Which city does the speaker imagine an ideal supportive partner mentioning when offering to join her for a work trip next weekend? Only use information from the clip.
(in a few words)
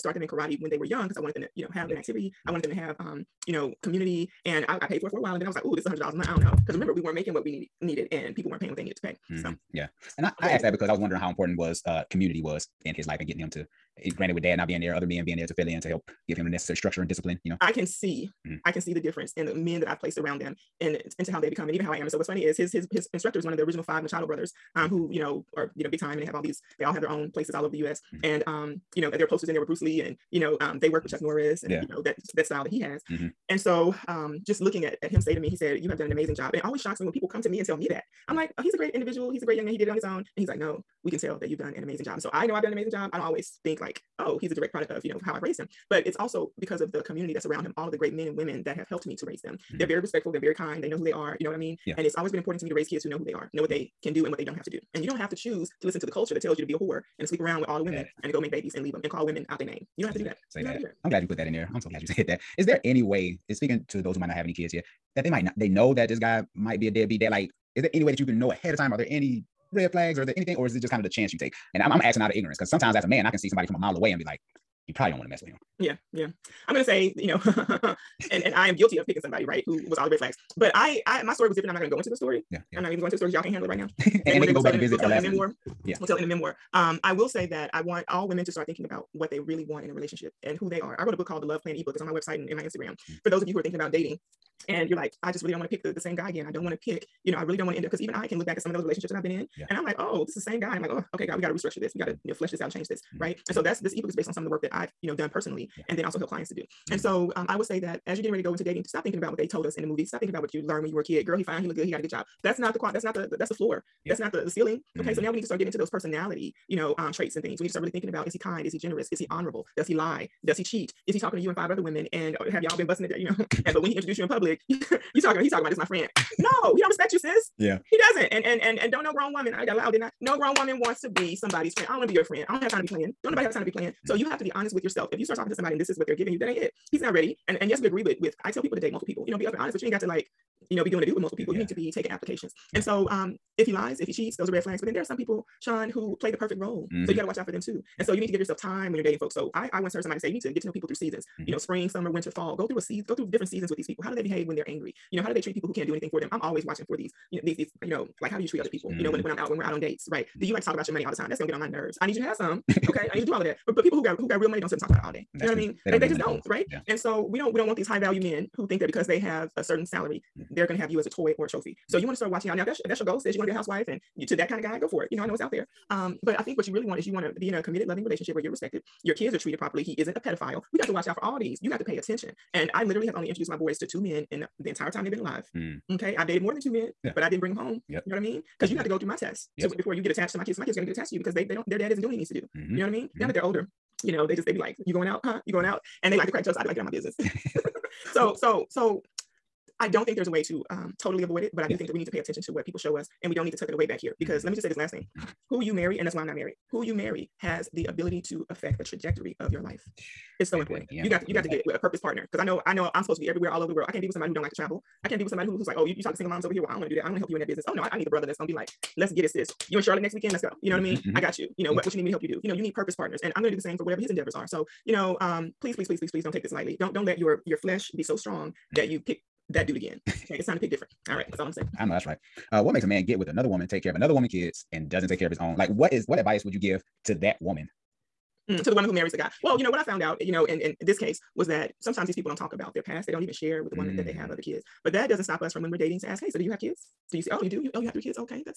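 Charlotte.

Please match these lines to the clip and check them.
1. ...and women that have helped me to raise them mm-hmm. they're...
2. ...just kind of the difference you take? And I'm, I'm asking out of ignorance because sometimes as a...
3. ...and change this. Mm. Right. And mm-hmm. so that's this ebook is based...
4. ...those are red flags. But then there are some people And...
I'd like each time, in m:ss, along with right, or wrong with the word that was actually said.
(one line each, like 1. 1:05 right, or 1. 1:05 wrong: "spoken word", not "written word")
1. 0:48 right
2. 1:10 wrong: "chance", not "difference"
3. 1:42 right
4. 2:24 wrong: "Sean", not "And".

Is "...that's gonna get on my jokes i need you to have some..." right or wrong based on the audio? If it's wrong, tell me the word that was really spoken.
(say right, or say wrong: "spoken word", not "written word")
wrong: "nerves", not "jokes".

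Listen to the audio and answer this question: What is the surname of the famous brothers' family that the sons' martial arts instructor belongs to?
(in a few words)
Machado.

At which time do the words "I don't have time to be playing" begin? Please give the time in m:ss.
2:12.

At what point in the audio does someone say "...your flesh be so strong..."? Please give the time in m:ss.
3:47.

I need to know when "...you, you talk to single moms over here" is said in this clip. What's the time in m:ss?
3:35.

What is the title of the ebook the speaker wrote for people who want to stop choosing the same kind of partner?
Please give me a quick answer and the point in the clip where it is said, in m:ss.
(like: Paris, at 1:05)
The Love Plan, at 1:31.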